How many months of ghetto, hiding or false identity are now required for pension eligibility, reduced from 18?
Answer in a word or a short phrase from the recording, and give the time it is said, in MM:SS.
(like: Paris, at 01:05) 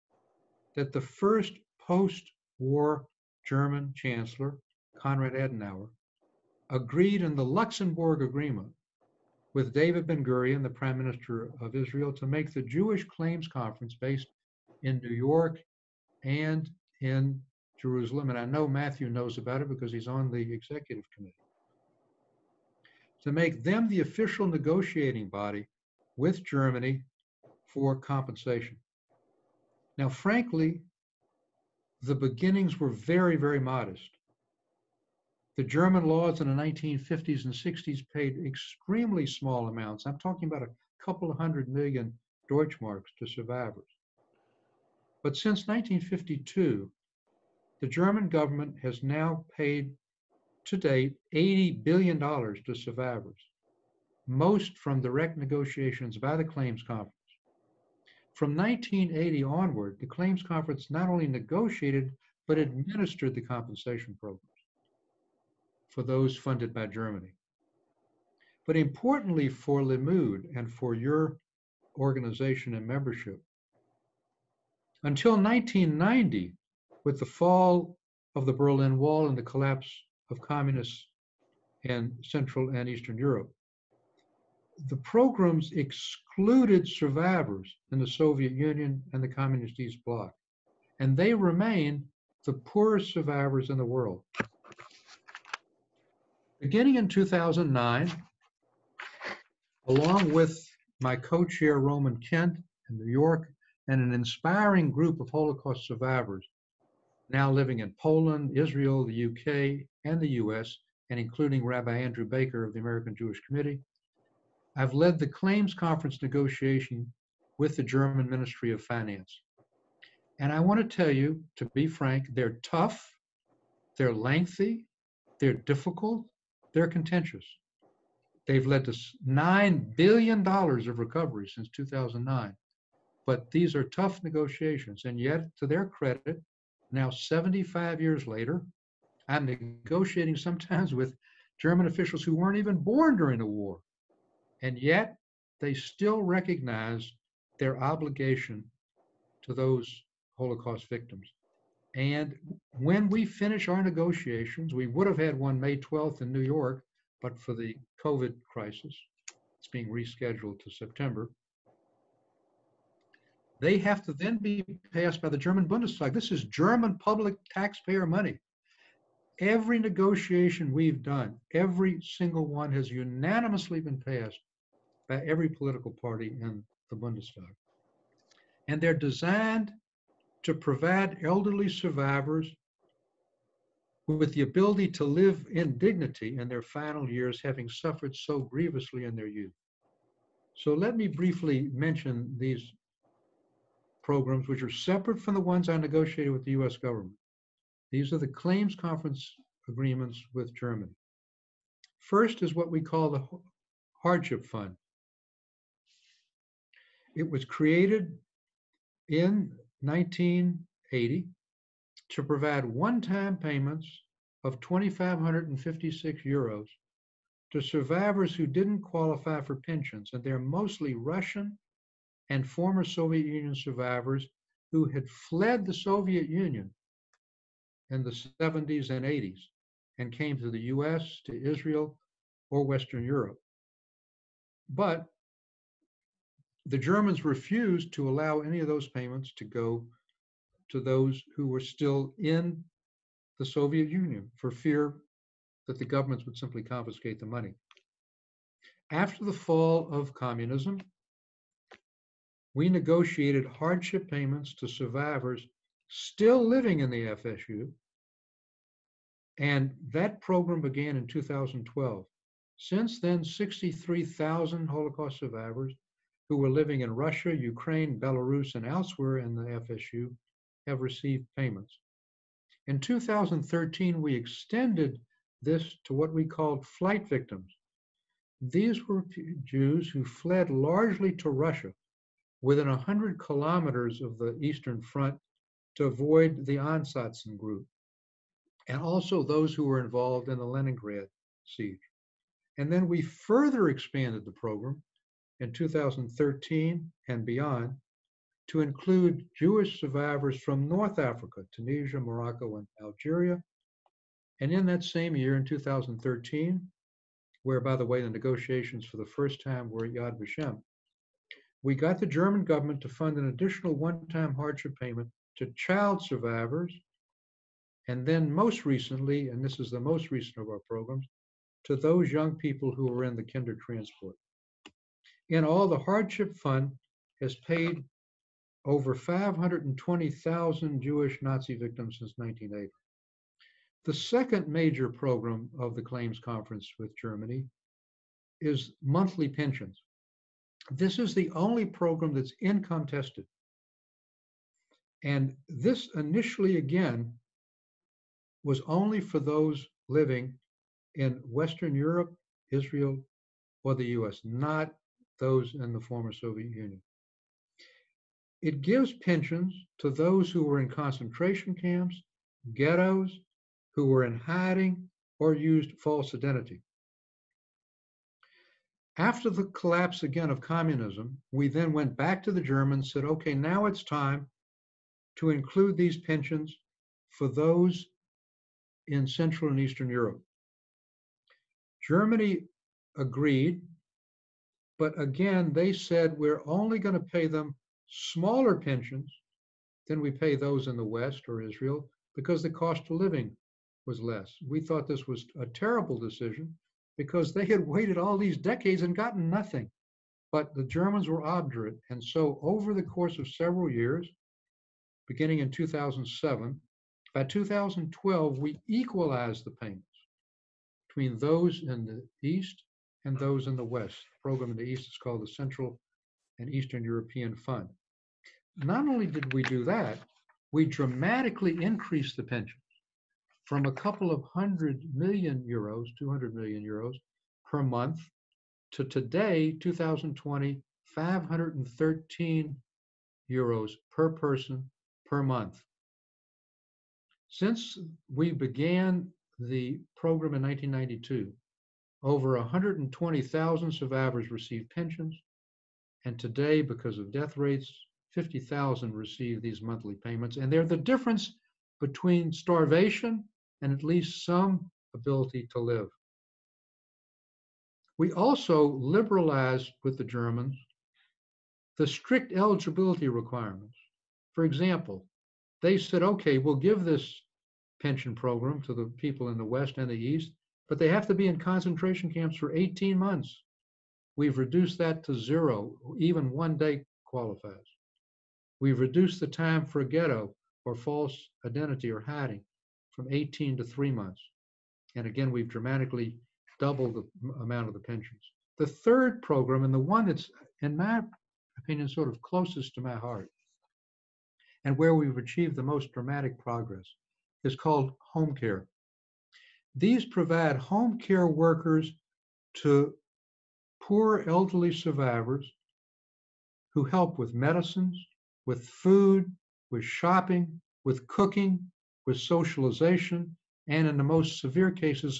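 3, at 08:03.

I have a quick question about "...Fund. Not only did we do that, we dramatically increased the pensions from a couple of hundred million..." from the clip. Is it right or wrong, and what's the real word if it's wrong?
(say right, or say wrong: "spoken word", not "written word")
right.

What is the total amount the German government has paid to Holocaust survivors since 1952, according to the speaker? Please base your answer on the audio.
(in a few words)
$80 billion.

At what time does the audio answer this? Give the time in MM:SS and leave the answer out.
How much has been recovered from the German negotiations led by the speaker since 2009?
02:09.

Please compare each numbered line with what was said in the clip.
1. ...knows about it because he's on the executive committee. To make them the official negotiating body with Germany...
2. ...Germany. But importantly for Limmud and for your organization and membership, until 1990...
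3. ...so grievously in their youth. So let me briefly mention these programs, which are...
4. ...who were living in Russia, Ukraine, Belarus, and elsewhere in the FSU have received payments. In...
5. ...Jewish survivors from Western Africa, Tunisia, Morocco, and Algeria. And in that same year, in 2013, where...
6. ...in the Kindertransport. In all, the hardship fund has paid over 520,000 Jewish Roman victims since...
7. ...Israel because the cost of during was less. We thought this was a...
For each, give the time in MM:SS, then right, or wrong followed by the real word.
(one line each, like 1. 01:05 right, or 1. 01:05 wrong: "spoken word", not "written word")
1. 00:19 right
2. 01:06 right
3. 03:08 right
4. 04:26 right
5. 04:59 wrong: "North", not "Western"
6. 05:23 wrong: "Nazi", not "Roman"
7. 06:31 wrong: "living", not "during".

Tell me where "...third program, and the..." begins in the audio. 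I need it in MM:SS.
08:08.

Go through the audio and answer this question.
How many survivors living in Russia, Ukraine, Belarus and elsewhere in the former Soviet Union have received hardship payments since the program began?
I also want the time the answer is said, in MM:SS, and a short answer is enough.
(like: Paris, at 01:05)
63,000, at 04:23.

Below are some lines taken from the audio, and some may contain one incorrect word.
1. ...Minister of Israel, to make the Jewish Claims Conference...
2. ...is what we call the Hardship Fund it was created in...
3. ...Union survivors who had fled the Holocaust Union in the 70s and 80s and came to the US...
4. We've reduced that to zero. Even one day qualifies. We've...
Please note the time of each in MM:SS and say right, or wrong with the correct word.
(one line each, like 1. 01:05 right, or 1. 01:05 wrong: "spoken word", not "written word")
1. 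00:10 right
2. 03:22 right
3. 03:43 wrong: "Soviet", not "Holocaust"
4. 07:54 right.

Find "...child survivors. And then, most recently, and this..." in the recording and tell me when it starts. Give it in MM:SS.
05:15.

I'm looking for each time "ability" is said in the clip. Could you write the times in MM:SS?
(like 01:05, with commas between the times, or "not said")
03:04, 07:34.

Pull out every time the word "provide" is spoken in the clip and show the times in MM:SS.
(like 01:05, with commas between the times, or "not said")
03:00, 03:32, 08:20.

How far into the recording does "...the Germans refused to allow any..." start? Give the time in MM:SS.
03:56.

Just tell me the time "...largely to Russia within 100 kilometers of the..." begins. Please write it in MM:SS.
04:40.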